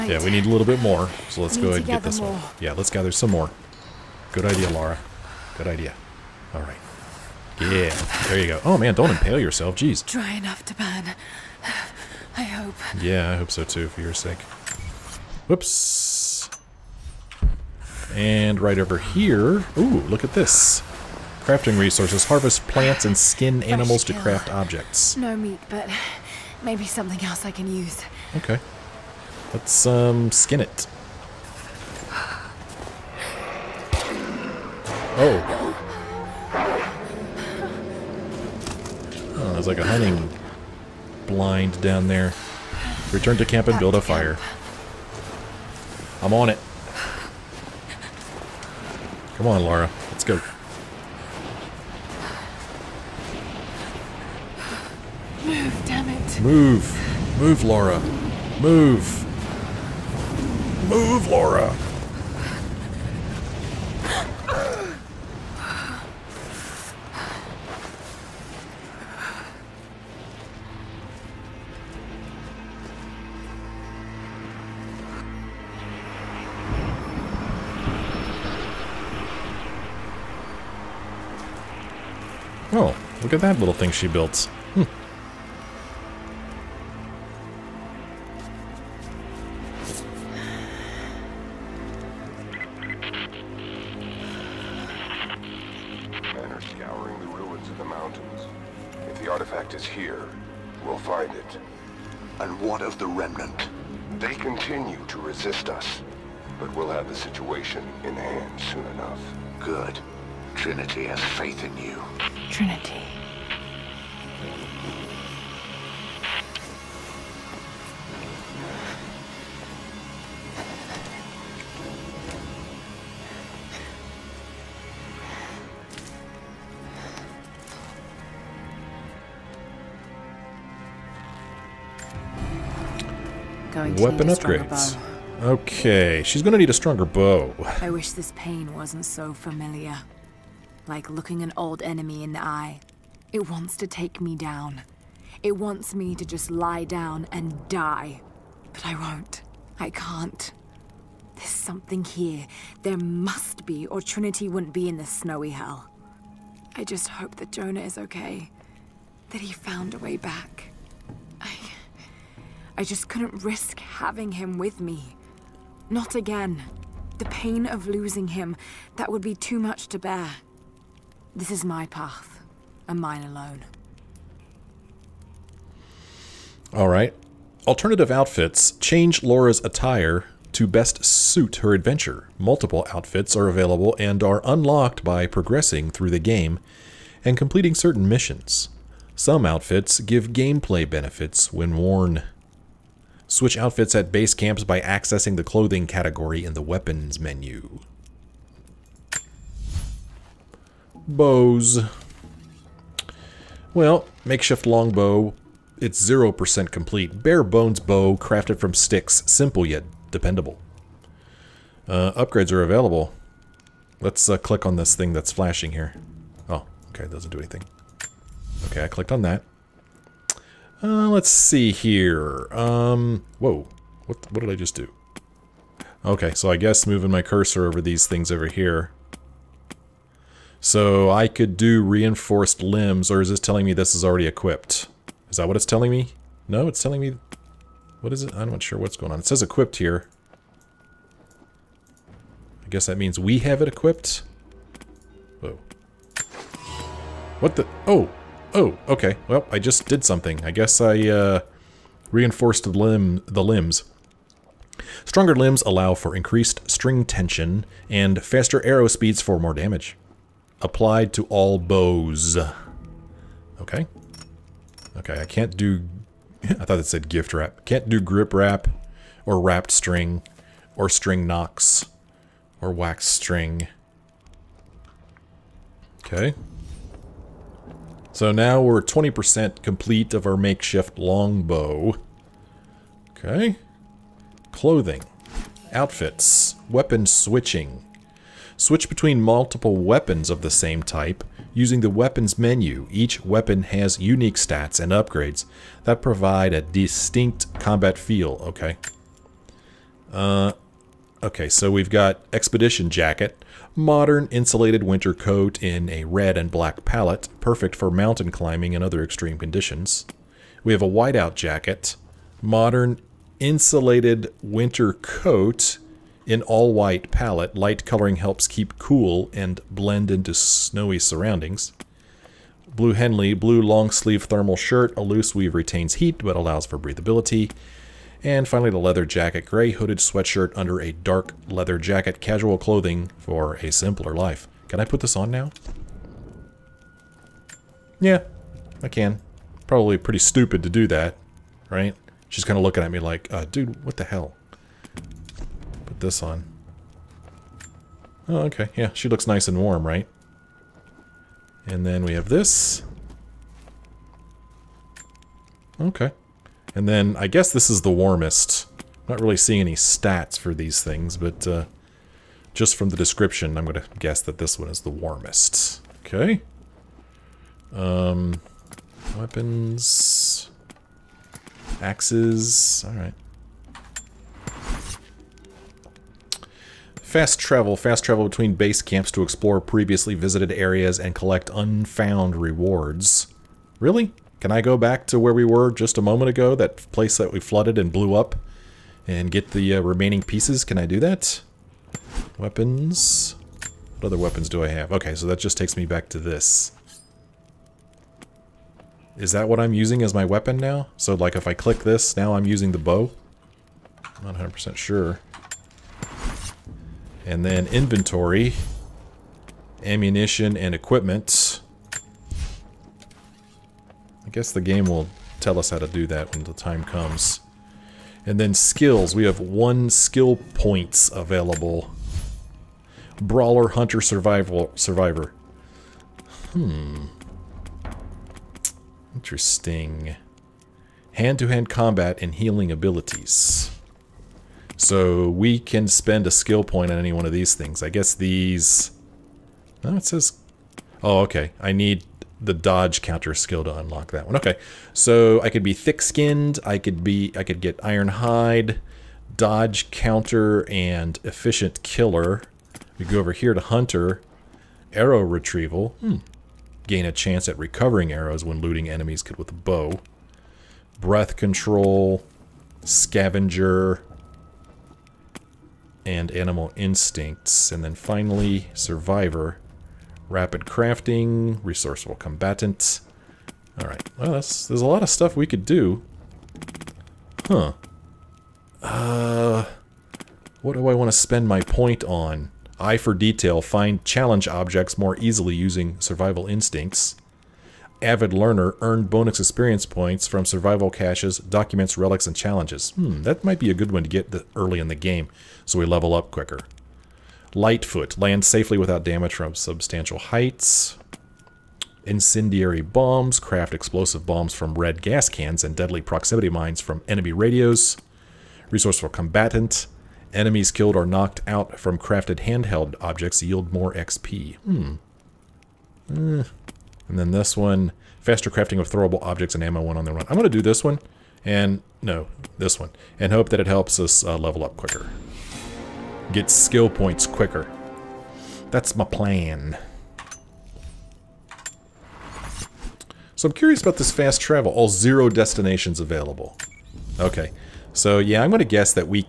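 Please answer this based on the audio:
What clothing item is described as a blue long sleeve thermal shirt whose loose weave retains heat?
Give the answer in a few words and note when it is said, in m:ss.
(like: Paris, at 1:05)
Blue Henley, at 5:22.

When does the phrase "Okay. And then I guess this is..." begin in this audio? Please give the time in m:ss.
5:55.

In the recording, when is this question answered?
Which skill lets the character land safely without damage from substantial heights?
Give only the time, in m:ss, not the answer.
8:17.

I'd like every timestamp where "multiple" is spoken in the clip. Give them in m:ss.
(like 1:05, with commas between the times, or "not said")
3:02, 4:49.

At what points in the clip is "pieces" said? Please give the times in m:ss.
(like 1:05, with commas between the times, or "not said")
6:30.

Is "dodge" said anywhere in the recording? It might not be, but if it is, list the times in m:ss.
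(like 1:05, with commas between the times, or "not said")
7:22, 7:29.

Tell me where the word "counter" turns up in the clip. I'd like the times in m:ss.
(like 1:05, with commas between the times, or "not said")
7:23, 7:29.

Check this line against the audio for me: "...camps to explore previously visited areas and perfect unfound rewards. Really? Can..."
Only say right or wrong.
wrong.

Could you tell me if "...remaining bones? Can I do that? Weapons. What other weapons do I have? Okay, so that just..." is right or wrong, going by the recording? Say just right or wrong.
wrong.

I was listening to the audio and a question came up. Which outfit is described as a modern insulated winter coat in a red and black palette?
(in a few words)
Expedition Jacket.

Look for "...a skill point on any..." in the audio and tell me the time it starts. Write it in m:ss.
7:16.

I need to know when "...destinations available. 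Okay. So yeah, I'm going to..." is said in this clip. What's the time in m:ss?
8:55.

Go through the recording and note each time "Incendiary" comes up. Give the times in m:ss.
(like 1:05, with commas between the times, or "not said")
8:22.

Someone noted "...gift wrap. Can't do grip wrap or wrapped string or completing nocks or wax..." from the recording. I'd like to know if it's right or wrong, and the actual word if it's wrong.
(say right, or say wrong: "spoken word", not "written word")
wrong: "string", not "completing".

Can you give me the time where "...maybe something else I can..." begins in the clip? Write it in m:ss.
0:26.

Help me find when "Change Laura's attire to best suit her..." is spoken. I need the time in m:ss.
2:58.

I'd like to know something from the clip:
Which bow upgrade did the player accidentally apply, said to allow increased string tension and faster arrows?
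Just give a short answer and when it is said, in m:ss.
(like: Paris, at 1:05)
Reinforced limbs, at 3:51.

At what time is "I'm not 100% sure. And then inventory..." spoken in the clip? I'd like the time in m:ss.
6:44.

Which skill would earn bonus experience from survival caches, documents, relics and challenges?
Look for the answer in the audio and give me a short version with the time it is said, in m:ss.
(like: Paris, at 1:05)
Avid learner, at 8:08.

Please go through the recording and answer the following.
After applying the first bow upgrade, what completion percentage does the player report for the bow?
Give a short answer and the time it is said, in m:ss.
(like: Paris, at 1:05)
20%, at 4:38.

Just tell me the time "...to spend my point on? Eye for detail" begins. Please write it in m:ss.
8:01.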